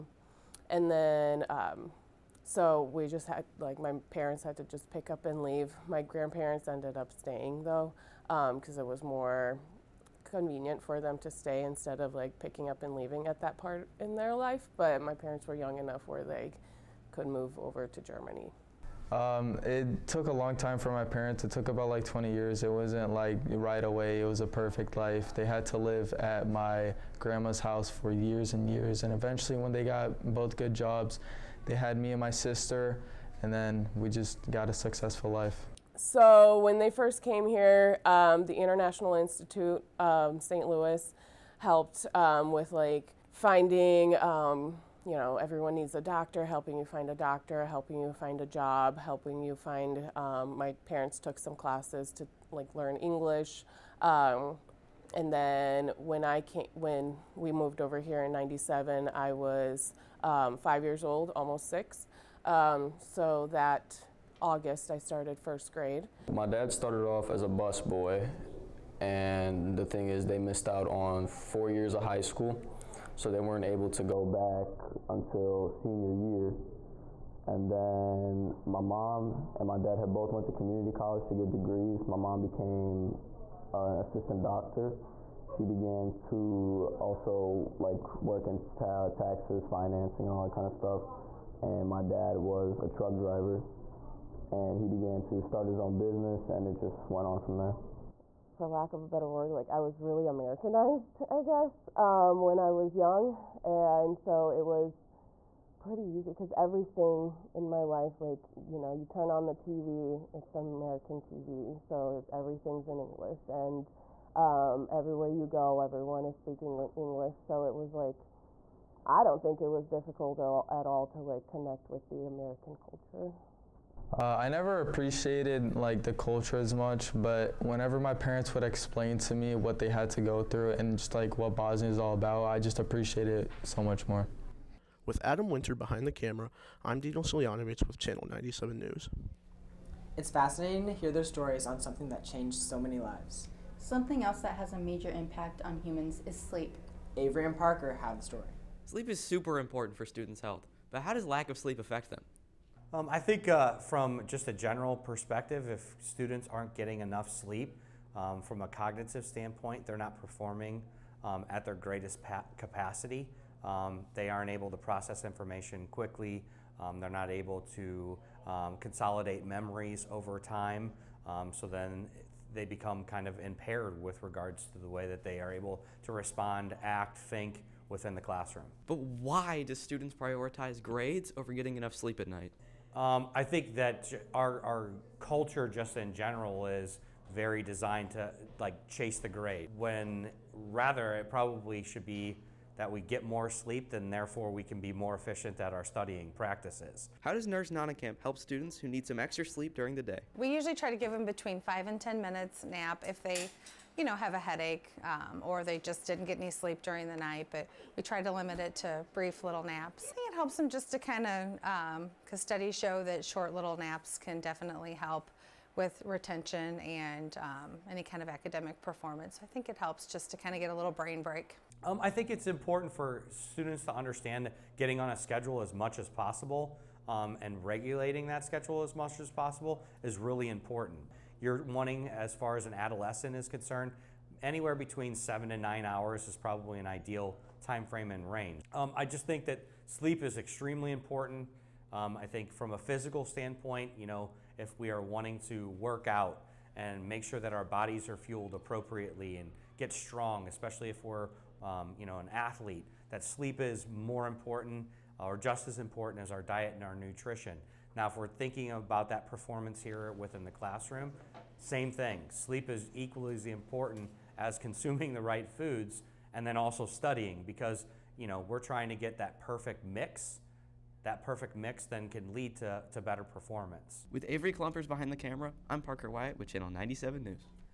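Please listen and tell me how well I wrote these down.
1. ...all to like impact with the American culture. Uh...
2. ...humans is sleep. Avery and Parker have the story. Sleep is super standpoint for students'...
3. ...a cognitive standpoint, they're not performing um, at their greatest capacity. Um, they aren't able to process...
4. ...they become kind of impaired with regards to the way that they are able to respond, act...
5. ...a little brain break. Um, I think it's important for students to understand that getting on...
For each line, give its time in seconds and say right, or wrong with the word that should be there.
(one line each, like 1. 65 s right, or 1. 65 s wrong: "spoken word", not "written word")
1. 120 s wrong: "connect", not "impact"
2. 145 s wrong: "important", not "standpoint"
3. 158 s right
4. 172 s right
5. 220 s right.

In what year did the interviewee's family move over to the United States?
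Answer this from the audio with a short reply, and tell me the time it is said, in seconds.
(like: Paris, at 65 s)
1997, at 58 s.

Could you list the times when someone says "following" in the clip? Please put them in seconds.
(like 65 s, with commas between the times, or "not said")
not said.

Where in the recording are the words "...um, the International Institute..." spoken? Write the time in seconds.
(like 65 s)
38 s.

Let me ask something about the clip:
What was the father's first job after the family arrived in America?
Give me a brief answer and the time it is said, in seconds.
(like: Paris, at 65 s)
bus boy, at 67 s.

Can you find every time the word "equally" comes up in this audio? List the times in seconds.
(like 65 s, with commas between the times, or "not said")
262 s.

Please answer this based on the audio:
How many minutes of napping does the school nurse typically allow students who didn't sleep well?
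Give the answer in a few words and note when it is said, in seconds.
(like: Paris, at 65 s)
5 to 10 minutes, at 201 s.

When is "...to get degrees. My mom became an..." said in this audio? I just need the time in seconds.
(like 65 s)
81 s.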